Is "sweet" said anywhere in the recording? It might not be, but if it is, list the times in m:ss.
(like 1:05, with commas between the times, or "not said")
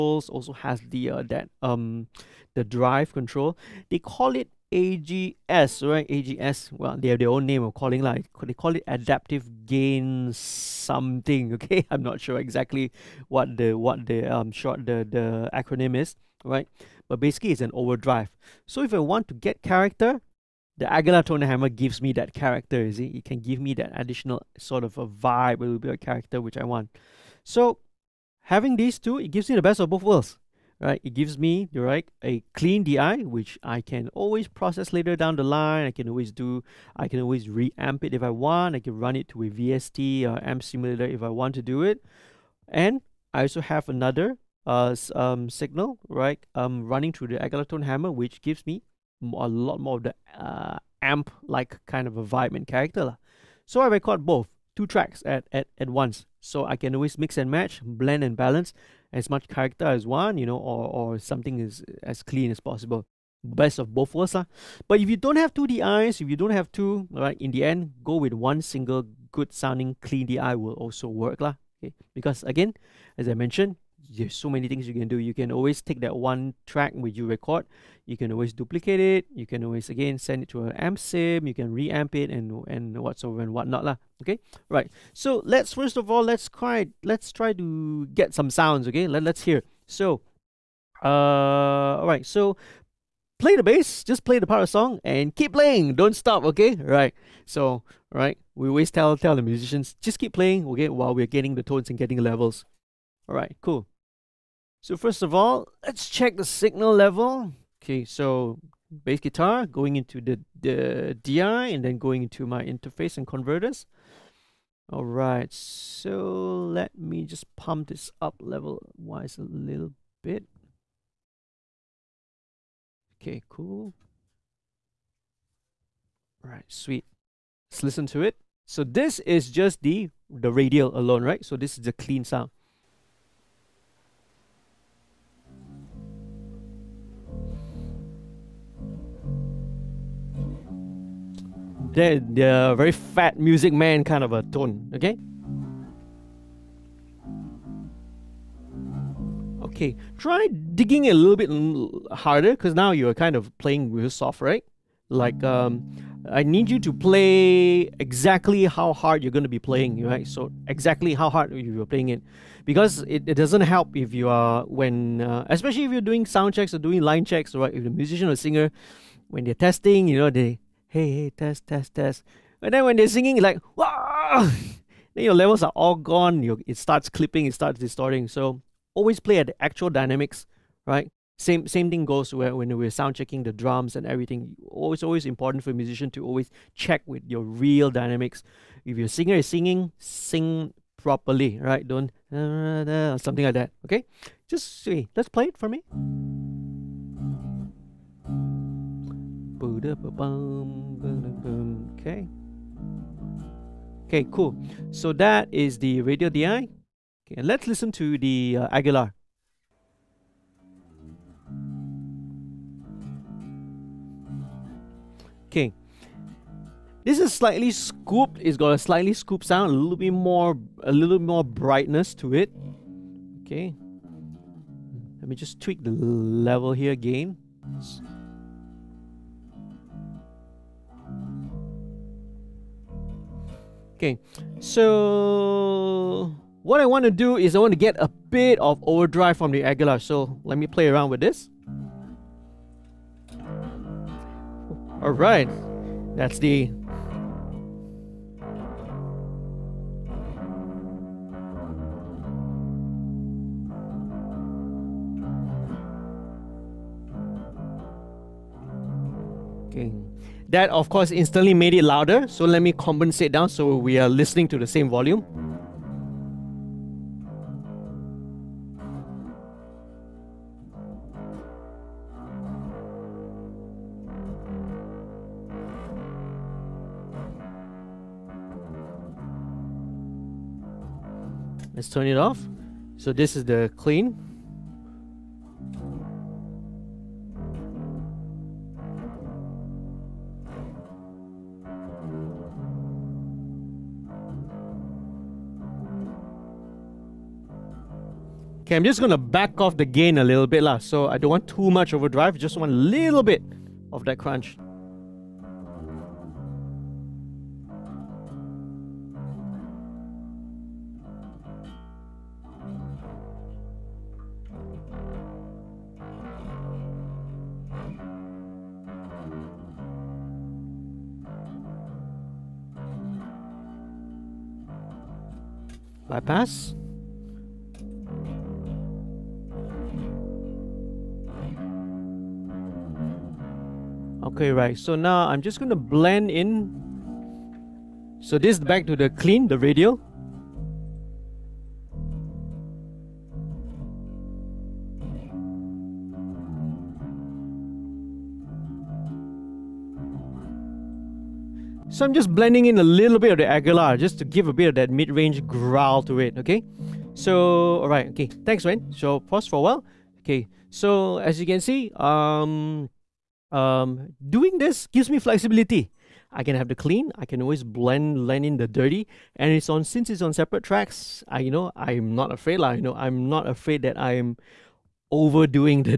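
2:06.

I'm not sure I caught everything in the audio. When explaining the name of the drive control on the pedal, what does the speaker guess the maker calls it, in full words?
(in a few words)
adaptive gain.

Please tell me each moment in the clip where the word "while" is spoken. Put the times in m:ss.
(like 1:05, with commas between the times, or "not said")
1:40, 5:59.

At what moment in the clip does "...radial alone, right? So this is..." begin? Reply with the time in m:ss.
2:10.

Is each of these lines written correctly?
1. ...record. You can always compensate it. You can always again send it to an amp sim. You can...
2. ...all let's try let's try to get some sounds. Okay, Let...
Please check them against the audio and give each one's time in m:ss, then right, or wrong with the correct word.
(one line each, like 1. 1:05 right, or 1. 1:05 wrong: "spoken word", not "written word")
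1. 1:17 wrong: "duplicate", not "compensate"
2. 1:26 right.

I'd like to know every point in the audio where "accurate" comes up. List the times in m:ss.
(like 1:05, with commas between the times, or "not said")
not said.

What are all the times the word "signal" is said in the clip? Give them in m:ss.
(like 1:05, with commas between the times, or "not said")
0:45, 1:46.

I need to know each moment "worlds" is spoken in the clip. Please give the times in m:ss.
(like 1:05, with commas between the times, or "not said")
0:30, 1:04.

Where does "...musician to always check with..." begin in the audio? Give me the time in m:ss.
3:05.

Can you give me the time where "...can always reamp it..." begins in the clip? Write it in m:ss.
0:37.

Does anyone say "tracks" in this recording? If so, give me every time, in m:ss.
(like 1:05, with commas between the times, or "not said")
0:54, 1:16, 6:10.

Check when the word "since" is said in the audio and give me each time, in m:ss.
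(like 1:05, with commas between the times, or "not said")
6:09.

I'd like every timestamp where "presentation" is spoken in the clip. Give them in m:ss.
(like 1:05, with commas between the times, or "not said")
not said.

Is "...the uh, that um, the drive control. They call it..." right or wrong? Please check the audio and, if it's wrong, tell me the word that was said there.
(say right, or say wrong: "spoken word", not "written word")
right.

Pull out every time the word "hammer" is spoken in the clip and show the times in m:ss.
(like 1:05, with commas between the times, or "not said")
0:21, 0:47.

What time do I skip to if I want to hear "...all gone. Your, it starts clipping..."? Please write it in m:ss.
2:55.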